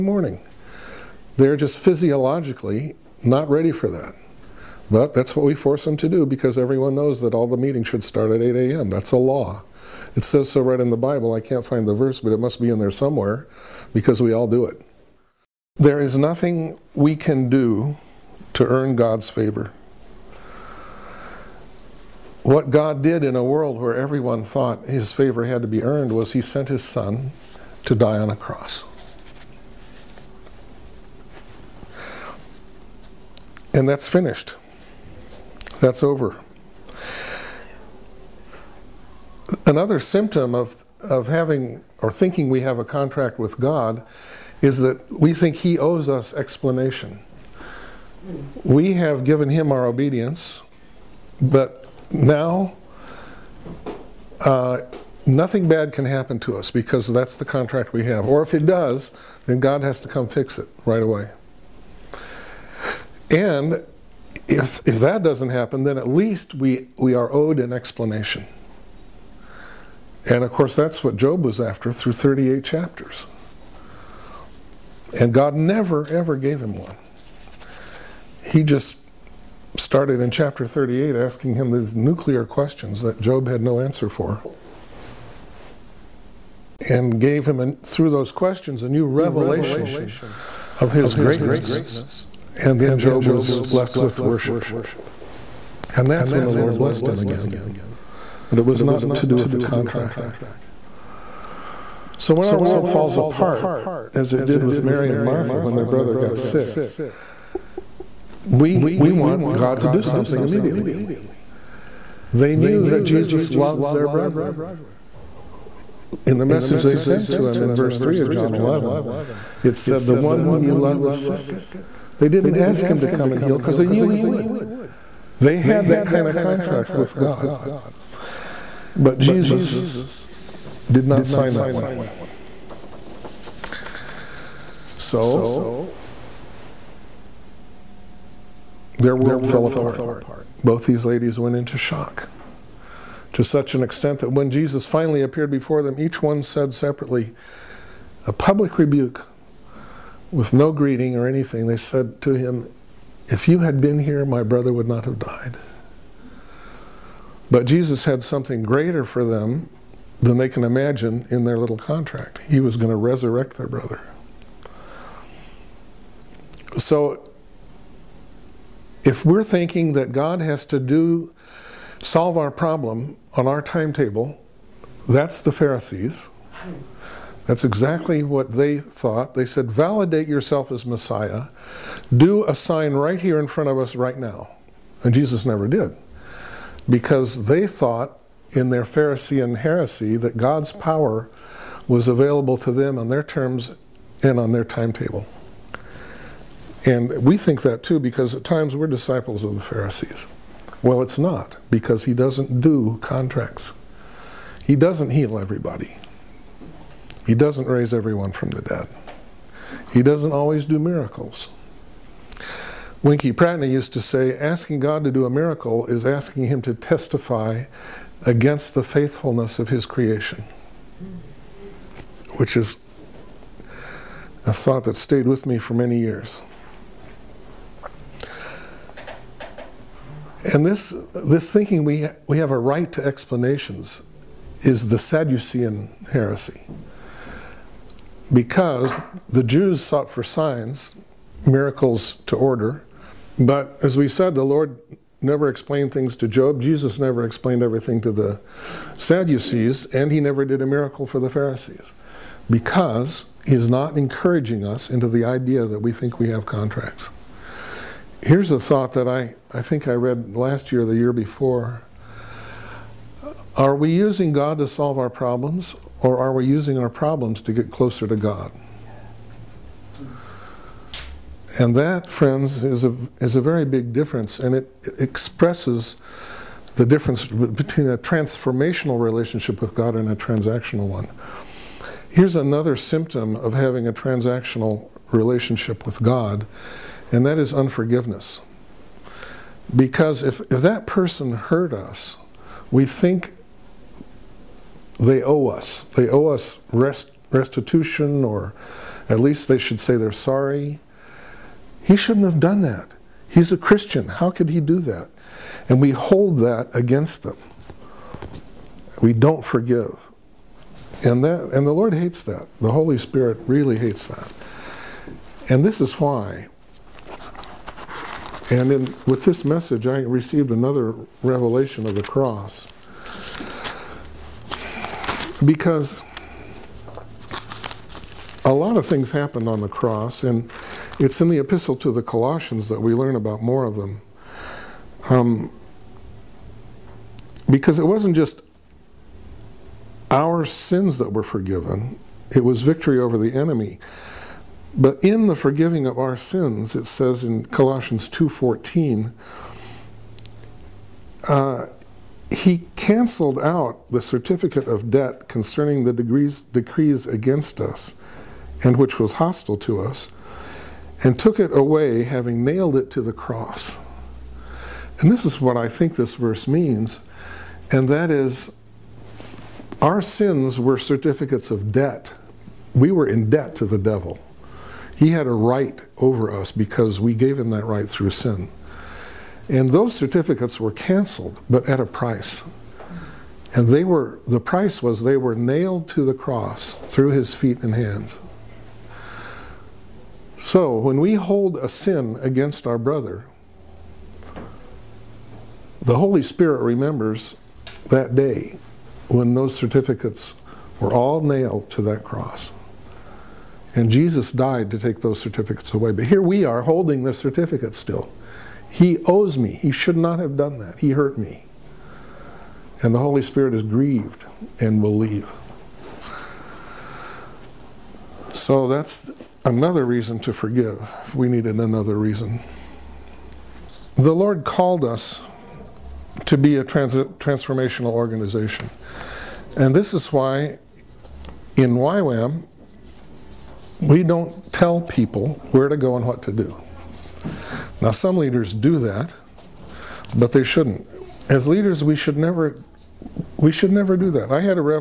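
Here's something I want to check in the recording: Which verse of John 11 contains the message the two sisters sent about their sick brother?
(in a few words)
verse 3.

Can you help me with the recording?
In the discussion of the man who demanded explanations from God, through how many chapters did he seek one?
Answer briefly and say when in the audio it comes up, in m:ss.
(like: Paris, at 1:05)
38, at 1:12.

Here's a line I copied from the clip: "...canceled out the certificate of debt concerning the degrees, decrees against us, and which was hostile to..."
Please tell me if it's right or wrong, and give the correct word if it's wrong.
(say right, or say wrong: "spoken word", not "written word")
right.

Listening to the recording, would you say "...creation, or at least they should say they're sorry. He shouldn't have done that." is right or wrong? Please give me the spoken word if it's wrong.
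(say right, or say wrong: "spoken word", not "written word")
wrong: "restitution", not "creation".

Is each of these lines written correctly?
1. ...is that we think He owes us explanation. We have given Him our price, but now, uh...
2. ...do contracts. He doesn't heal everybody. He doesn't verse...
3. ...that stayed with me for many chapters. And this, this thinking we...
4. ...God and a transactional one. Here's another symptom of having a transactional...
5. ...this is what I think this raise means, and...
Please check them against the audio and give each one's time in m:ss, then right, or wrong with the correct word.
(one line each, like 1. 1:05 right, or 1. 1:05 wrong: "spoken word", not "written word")
1. 0:44 wrong: "obedience", not "price"
2. 3:22 wrong: "raise", not "verse"
3. 3:44 wrong: "years", not "chapters"
4. 4:39 right
5. 6:05 wrong: "verse", not "raise".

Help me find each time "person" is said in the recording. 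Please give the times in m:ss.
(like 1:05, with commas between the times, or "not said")
4:50.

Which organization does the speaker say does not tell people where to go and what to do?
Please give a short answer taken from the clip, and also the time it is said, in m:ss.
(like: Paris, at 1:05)
YWAM, at 7:11.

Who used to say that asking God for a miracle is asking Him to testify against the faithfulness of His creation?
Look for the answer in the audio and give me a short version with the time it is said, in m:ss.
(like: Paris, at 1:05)
Winkie Pratney, at 3:33.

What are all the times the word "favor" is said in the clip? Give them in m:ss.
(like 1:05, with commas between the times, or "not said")
0:19, 0:25.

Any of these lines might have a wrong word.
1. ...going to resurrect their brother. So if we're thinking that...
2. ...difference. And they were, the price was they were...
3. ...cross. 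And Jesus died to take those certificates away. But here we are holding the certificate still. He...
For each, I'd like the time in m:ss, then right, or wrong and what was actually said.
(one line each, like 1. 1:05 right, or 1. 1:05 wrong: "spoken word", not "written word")
1. 2:42 right
2. 6:21 wrong: "price", not "difference"
3. 6:42 right.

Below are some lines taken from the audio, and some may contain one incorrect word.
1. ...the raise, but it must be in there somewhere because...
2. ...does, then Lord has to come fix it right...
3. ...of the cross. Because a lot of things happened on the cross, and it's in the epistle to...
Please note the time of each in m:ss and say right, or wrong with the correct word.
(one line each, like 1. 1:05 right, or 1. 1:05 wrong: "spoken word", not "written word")
1. 0:11 wrong: "verse", not "raise"
2. 0:58 wrong: "God", not "Lord"
3. 5:21 right.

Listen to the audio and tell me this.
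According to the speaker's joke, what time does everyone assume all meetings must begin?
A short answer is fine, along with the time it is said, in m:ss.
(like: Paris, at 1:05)
8 a.m., at 0:08.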